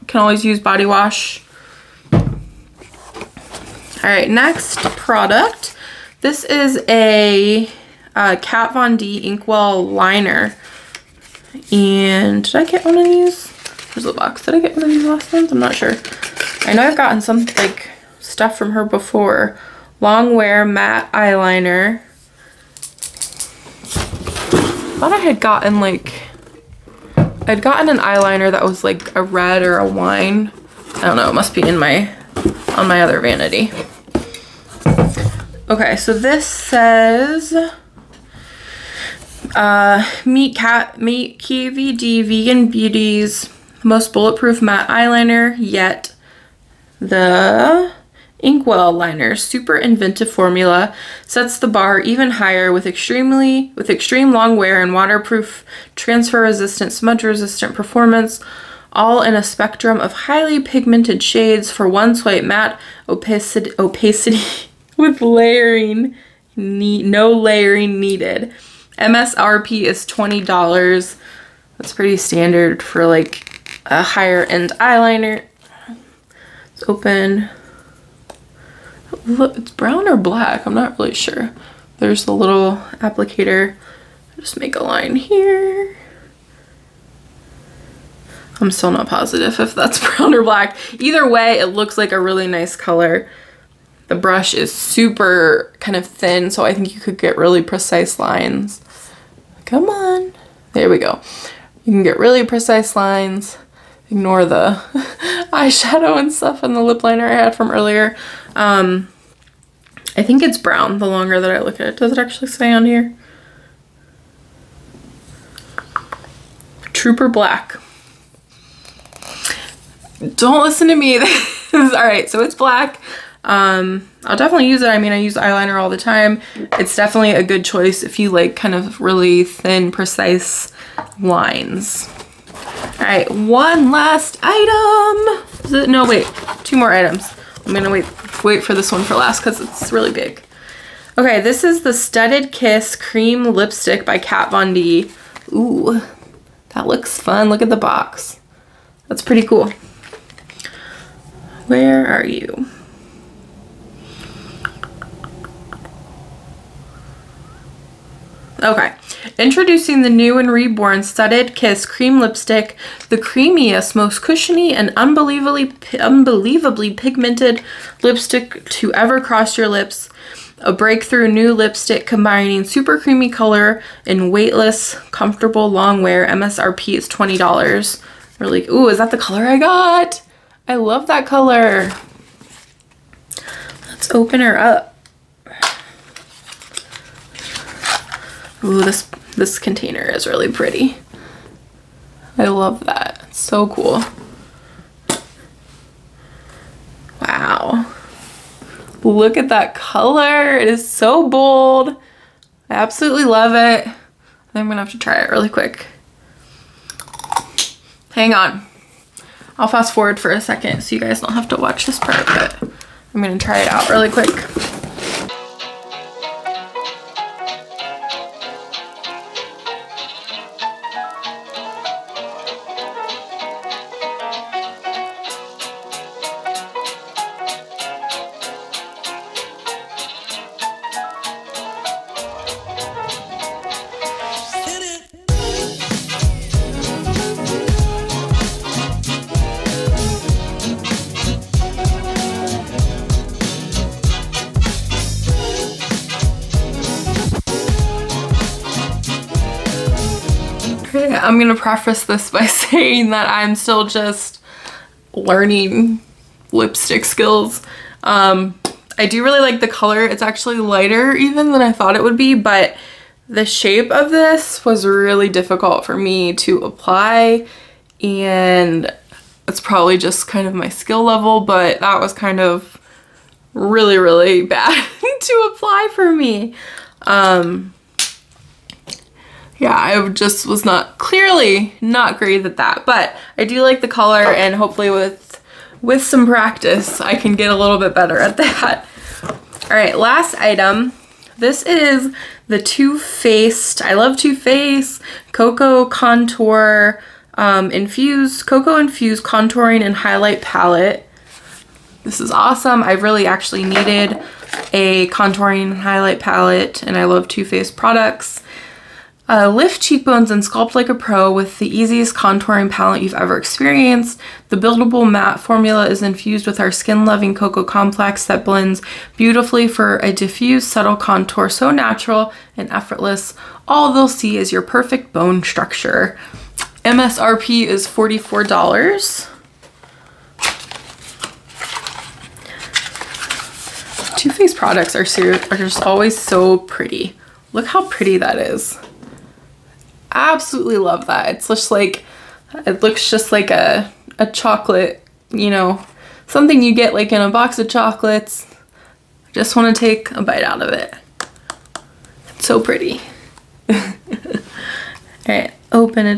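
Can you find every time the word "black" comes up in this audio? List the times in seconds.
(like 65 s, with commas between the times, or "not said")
80 s, 90 s, 117 s, 122 s.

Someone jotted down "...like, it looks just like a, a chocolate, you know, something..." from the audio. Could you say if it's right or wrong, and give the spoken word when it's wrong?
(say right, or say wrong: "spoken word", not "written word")
right.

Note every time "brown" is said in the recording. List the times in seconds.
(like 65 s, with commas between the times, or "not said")
79 s, 90 s, 110 s.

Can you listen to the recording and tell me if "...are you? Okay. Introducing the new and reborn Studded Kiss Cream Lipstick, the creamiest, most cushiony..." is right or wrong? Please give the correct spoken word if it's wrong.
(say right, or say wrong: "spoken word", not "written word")
right.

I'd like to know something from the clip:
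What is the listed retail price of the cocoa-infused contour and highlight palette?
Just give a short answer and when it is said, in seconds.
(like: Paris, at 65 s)
$44, at 327 s.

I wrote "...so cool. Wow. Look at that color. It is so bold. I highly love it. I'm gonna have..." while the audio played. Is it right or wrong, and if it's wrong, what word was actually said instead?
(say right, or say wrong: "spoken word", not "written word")
wrong: "absolutely", not "highly".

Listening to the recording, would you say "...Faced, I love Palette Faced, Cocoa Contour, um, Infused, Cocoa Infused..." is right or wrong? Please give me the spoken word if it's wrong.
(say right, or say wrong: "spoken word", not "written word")
wrong: "Too", not "Palette".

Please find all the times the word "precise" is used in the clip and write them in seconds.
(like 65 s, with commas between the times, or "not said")
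97 s, 102 s, 129 s.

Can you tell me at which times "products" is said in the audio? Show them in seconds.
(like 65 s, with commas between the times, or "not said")
4 s, 307 s, 334 s.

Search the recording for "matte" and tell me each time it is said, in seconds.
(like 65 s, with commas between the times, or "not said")
20 s, 44 s, 62 s, 315 s.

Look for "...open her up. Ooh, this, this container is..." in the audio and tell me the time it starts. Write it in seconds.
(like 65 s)
184 s.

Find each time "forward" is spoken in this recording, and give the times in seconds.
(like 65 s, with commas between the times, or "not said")
209 s.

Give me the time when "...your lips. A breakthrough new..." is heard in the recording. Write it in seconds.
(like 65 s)
169 s.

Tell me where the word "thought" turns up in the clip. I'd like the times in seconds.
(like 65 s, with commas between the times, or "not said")
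24 s, 261 s.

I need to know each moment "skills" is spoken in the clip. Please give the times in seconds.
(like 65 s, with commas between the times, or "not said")
257 s, 270 s.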